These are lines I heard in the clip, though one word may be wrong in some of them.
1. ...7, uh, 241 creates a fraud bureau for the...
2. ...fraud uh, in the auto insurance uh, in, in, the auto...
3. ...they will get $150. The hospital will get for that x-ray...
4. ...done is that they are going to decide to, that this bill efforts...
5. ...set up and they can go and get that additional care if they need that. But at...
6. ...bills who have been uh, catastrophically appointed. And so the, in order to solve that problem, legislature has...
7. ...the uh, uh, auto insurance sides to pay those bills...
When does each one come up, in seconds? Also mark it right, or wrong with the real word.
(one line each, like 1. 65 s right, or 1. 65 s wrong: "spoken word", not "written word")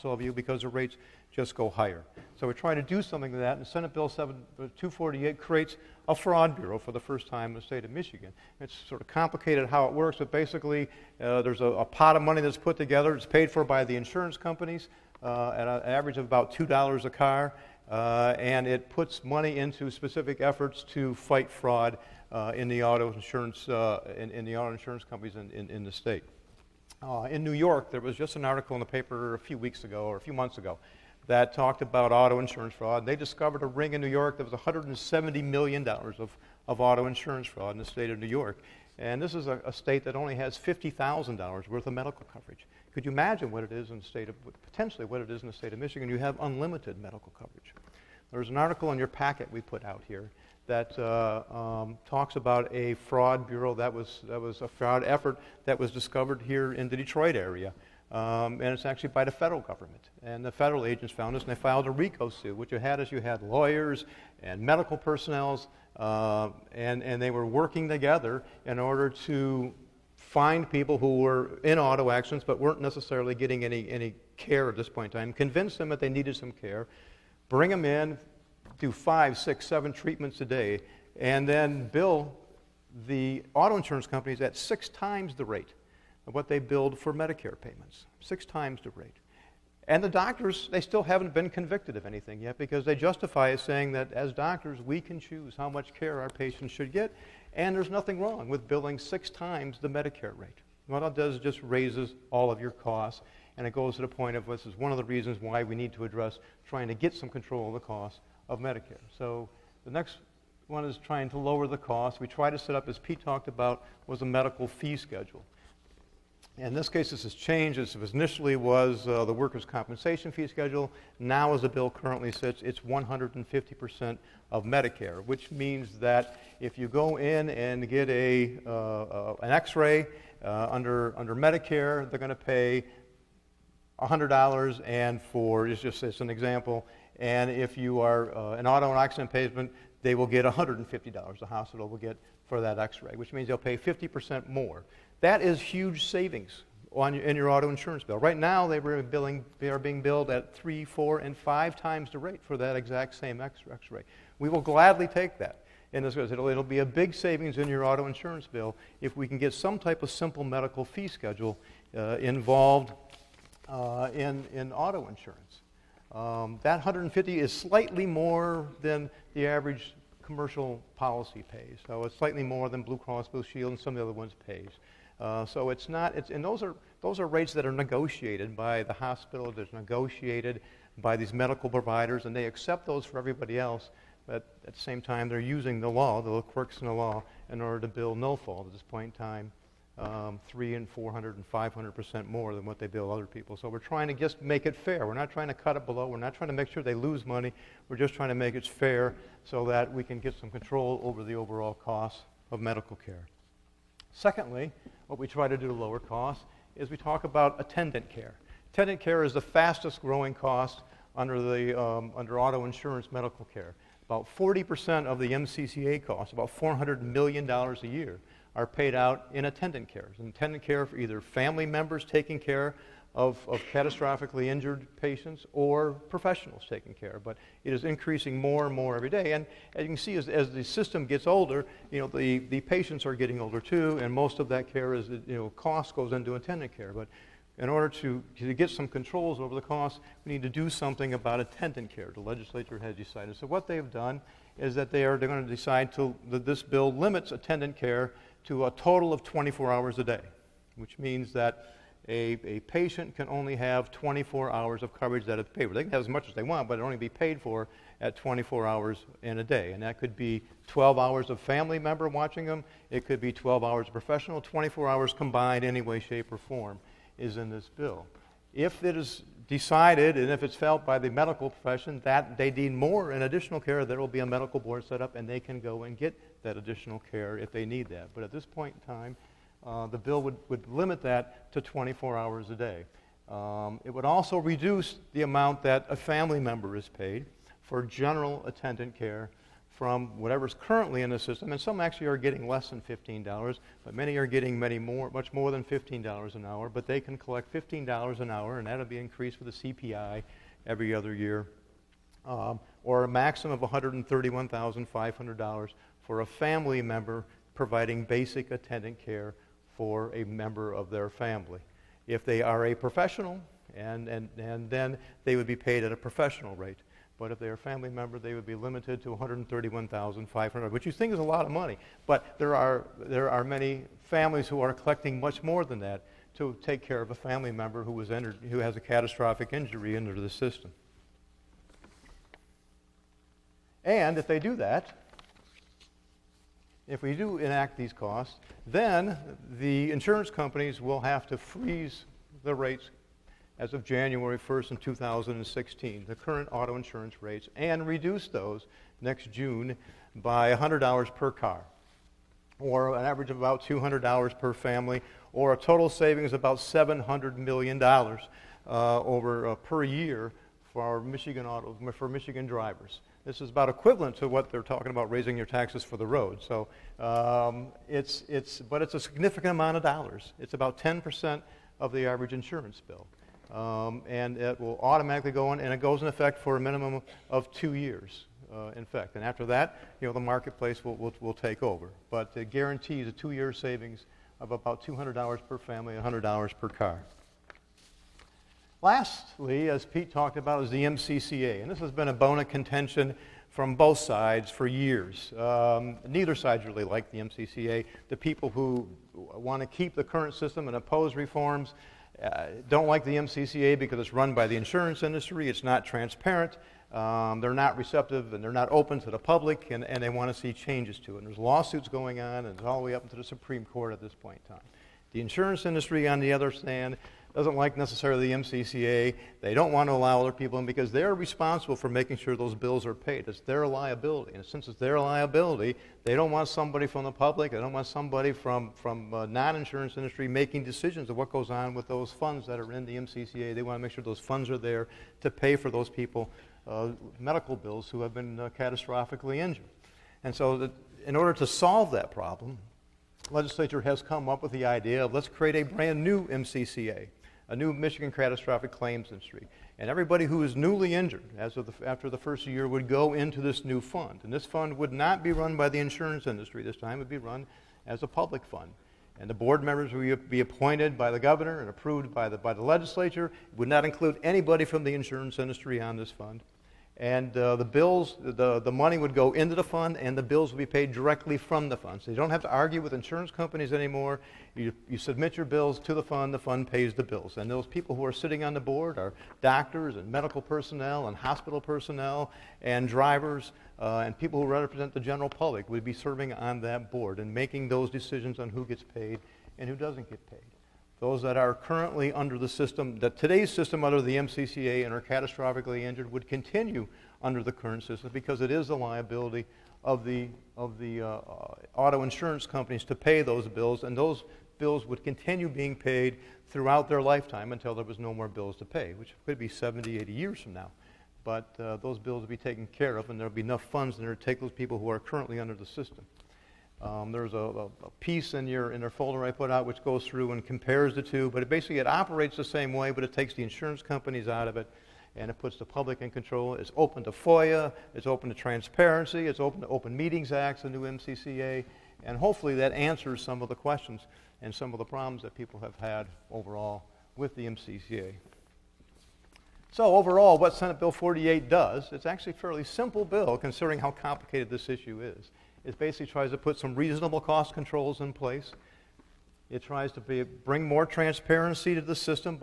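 1. 4 s wrong: "248", not "241"
2. 21 s right
3. 140 s right
4. 243 s wrong: "limits", not "efforts"
5. 274 s right
6. 437 s wrong: "injured", not "appointed"
7. 500 s wrong: "companies", not "sides".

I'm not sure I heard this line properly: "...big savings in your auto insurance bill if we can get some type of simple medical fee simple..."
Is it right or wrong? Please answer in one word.
wrong.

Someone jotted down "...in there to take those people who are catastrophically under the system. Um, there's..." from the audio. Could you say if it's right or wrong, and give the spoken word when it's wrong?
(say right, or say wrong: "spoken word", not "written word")
wrong: "currently", not "catastrophically".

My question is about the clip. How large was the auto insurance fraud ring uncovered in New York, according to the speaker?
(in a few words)
$170 million.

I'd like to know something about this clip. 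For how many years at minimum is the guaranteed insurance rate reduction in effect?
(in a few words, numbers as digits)
2 years.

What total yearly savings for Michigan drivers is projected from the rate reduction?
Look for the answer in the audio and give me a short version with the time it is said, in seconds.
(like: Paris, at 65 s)
$700 million, at 356 s.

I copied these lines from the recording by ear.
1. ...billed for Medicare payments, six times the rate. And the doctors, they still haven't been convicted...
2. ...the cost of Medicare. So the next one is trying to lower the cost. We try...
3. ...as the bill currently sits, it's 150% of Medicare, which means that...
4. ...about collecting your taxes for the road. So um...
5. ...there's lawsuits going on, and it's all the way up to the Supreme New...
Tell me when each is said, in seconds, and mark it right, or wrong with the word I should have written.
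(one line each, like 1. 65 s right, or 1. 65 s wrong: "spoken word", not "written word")
1. 86 s right
2. 107 s right
3. 121 s right
4. 364 s wrong: "raising", not "collecting"
5. 411 s wrong: "Court", not "New".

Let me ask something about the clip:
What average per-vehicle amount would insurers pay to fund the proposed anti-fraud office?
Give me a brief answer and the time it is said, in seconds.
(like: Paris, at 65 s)
$2, at 16 s.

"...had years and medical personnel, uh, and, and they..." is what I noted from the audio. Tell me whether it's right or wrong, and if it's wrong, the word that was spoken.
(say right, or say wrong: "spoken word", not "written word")
wrong: "lawyers", not "years".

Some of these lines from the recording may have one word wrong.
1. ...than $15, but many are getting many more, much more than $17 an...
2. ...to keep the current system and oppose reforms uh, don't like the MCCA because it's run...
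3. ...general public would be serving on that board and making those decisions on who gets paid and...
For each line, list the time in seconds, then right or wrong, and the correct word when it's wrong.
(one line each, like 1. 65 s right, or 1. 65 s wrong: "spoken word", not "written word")
1. 292 s wrong: "15", not "17"
2. 399 s right
3. 484 s right.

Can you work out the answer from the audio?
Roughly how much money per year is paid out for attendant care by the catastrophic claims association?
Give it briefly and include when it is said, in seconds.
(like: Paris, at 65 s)
$400 million, at 216 s.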